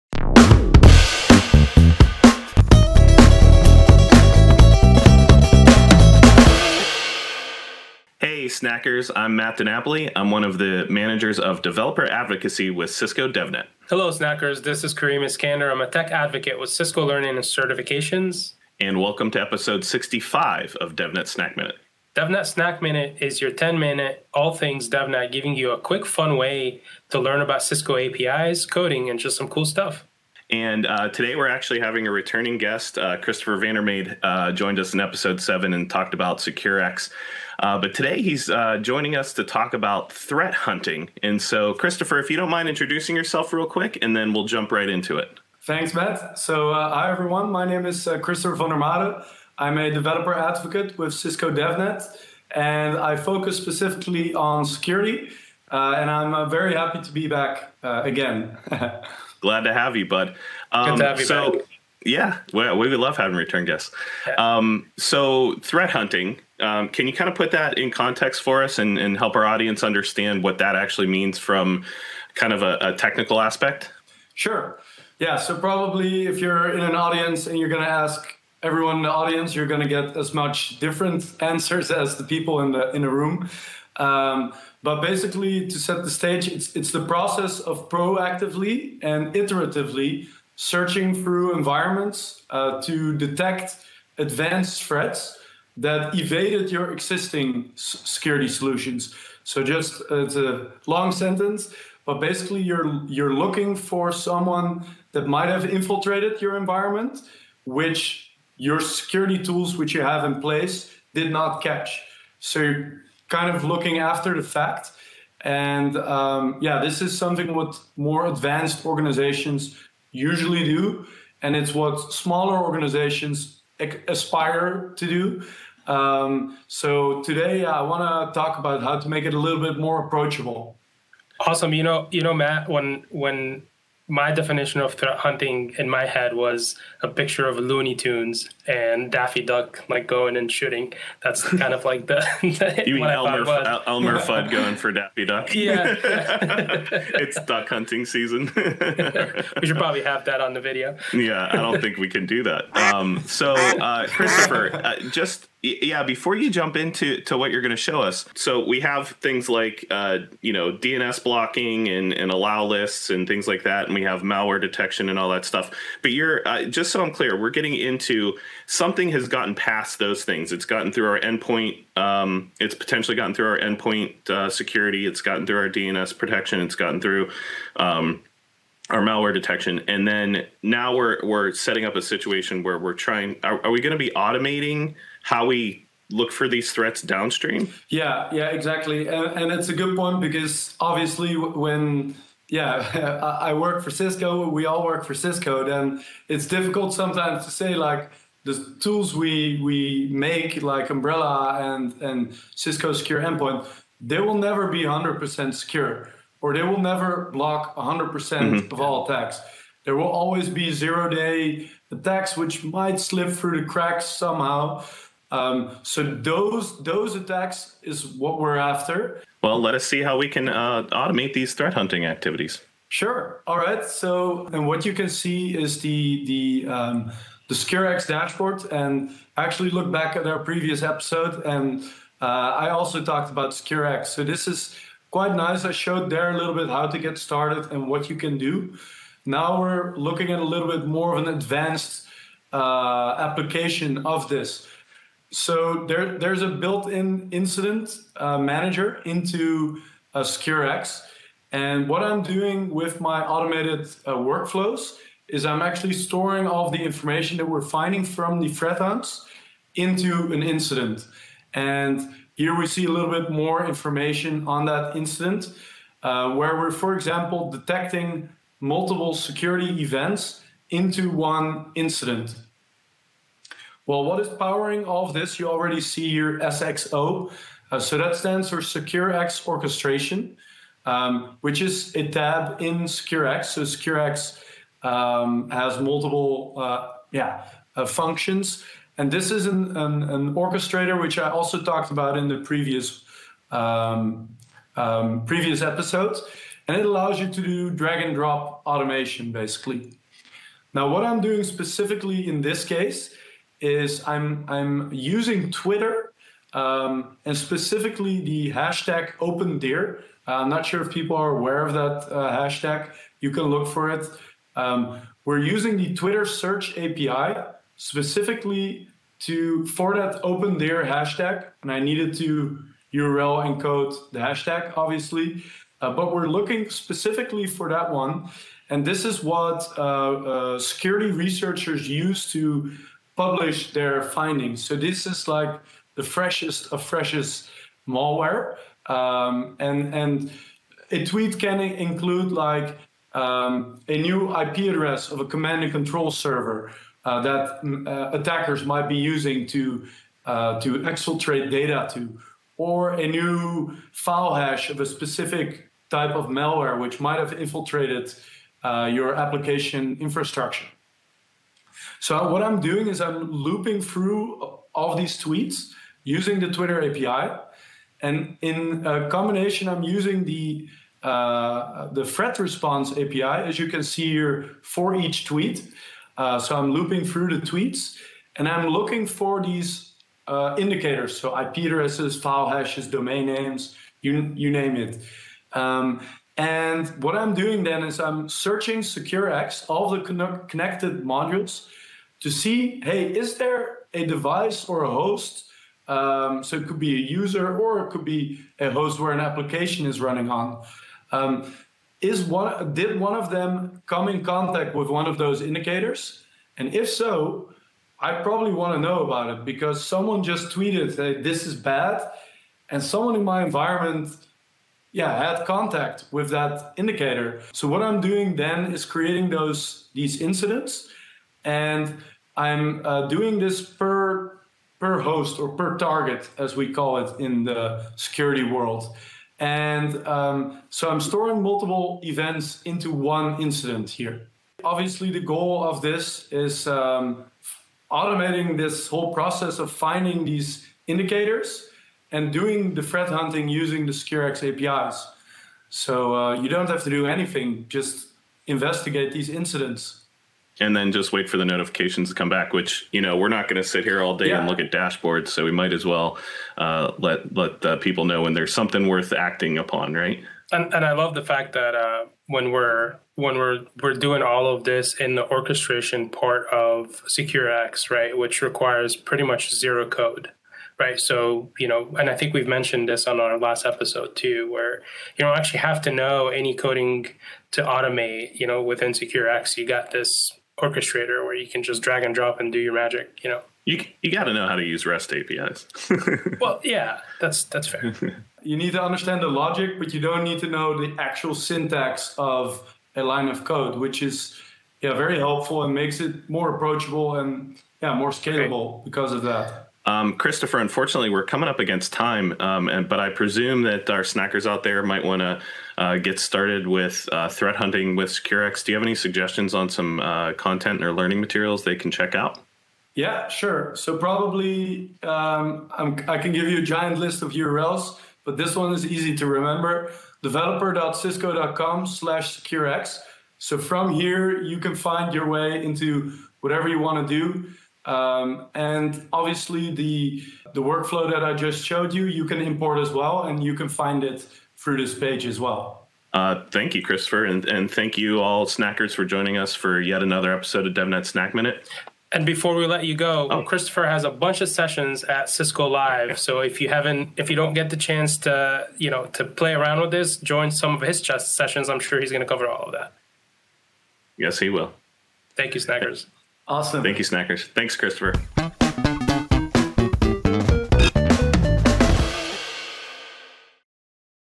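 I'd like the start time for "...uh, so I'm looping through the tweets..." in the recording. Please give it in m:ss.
6:16.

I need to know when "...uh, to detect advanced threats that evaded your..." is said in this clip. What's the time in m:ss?
1:32.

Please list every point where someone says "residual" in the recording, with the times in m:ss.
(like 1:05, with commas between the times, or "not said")
not said.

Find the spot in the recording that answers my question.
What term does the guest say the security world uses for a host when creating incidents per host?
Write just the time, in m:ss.
7:05.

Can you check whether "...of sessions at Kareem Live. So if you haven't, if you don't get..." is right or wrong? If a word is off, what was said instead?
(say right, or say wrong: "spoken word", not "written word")
wrong: "Cisco", not "Kareem".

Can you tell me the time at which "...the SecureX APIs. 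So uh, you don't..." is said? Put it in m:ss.
7:23.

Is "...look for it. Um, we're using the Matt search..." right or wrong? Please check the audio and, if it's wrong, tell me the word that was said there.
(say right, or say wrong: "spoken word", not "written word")
wrong: "Twitter", not "Matt".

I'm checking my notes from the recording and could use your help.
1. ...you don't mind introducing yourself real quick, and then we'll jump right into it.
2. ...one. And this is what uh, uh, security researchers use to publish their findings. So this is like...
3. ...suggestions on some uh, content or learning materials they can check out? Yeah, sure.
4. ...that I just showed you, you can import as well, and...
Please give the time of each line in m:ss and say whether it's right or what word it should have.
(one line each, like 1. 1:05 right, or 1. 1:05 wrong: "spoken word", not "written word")
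1. 0:42 right
2. 5:27 right
3. 8:28 right
4. 8:51 right.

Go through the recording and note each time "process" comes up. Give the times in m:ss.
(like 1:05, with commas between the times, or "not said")
1:27, 7:19.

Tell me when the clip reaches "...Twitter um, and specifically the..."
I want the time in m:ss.
5:05.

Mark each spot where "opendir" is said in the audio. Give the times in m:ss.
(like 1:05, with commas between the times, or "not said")
5:09, 5:20.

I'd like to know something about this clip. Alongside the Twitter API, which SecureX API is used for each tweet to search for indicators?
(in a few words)
Threat Response API.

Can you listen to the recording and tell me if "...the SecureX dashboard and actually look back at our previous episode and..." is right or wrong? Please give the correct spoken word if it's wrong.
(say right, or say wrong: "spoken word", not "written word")
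right.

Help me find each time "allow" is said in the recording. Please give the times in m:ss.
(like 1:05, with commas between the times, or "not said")
2:42, 4:56.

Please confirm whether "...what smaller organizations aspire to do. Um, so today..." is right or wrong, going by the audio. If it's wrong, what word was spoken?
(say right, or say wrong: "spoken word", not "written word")
right.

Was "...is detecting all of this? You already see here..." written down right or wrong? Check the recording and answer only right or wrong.
wrong.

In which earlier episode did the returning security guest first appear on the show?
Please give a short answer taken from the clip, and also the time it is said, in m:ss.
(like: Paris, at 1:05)
Episode 7, at 0:34.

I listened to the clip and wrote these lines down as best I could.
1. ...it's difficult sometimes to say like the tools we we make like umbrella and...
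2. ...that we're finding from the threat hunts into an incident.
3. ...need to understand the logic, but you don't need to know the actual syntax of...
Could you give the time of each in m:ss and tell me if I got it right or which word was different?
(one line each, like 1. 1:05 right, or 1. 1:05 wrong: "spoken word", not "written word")
1. 3:16 right
2. 4:17 right
3. 8:08 right.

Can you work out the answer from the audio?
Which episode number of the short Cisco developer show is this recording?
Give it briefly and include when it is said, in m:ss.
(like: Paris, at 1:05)
65, at 0:19.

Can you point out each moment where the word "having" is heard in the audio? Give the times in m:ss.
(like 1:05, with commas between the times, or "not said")
0:31, 1:03.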